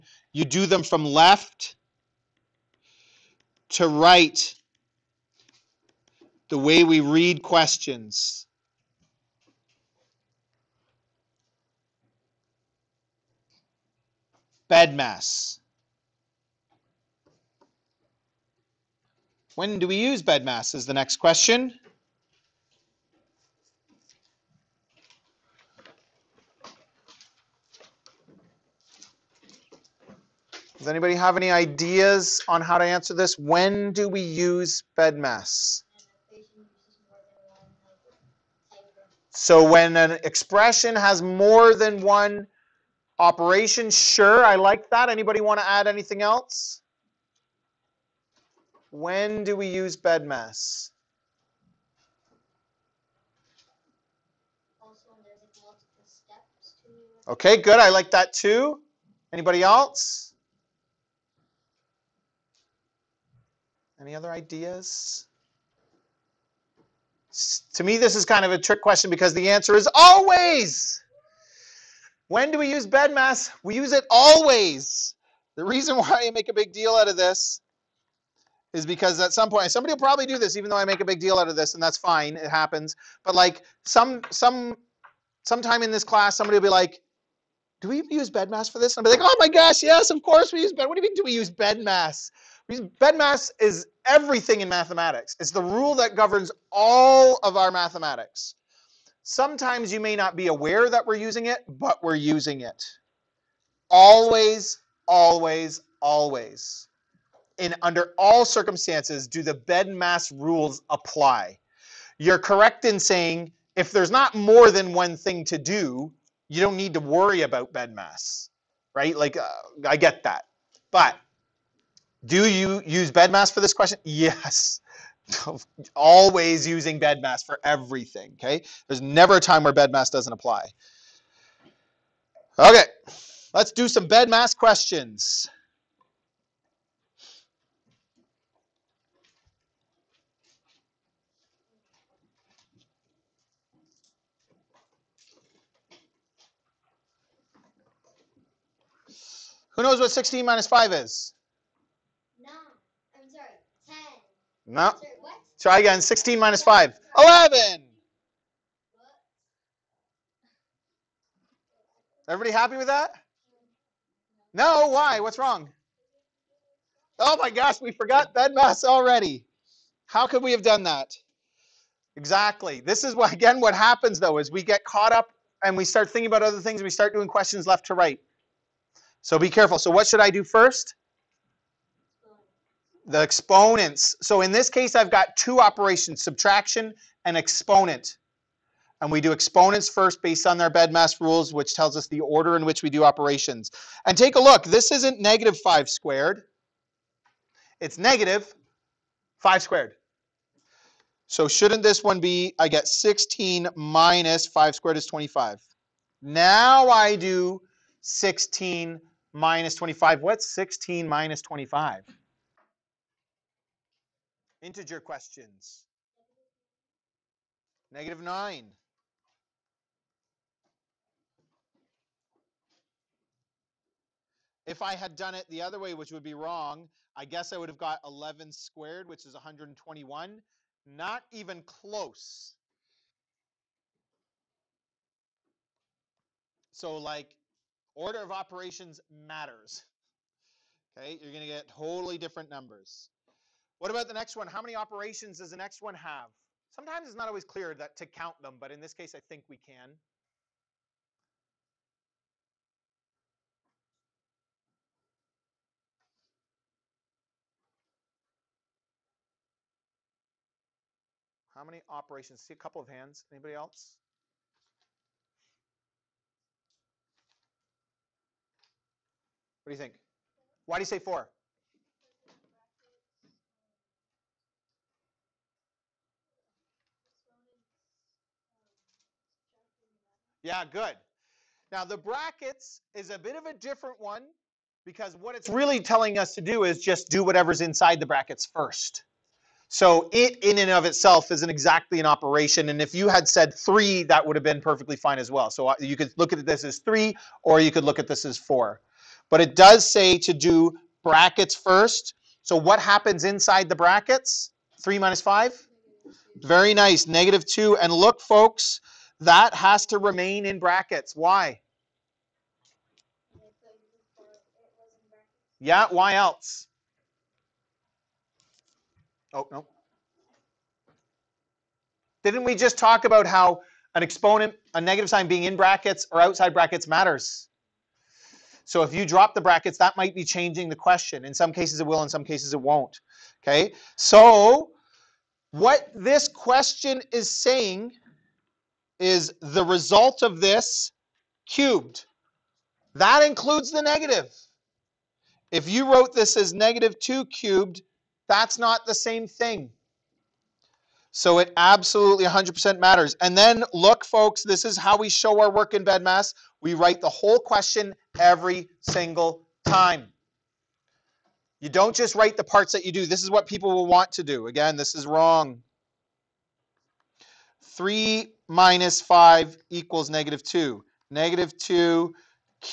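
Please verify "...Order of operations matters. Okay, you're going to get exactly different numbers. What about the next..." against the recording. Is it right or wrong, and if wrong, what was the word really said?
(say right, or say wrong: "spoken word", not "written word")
wrong: "totally", not "exactly".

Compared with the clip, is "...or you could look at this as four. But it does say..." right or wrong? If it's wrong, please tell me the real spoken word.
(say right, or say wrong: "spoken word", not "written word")
right.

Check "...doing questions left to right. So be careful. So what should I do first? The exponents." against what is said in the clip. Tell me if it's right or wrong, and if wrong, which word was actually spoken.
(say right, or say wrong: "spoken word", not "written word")
right.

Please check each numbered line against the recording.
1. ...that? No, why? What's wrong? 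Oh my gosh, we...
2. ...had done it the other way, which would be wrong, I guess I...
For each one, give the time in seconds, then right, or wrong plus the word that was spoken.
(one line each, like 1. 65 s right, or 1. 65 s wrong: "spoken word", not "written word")
1. 162 s right
2. 224 s right.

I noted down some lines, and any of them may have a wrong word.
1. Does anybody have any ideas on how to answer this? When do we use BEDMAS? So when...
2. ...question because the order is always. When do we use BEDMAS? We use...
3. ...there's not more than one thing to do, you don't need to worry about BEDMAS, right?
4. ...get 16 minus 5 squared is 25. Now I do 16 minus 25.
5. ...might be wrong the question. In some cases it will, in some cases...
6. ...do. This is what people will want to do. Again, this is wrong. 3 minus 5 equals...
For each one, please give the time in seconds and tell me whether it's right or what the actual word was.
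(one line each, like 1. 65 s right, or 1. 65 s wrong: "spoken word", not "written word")
1. 30 s right
2. 68 s wrong: "answer", not "order"
3. 113 s right
4. 202 s right
5. 329 s wrong: "changing", not "wrong"
6. 362 s right.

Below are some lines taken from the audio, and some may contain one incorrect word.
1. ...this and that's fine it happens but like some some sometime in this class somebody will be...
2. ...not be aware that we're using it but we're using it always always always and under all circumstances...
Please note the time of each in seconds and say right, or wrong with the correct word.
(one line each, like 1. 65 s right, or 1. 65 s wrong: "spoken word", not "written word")
1. 81 s right
2. 100 s right.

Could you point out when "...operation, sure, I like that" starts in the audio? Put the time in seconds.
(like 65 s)
43 s.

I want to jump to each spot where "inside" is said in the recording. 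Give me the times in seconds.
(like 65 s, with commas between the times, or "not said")
287 s, 303 s.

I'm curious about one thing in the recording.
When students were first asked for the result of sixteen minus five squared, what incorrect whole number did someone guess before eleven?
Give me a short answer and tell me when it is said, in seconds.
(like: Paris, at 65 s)
10, at 153 s.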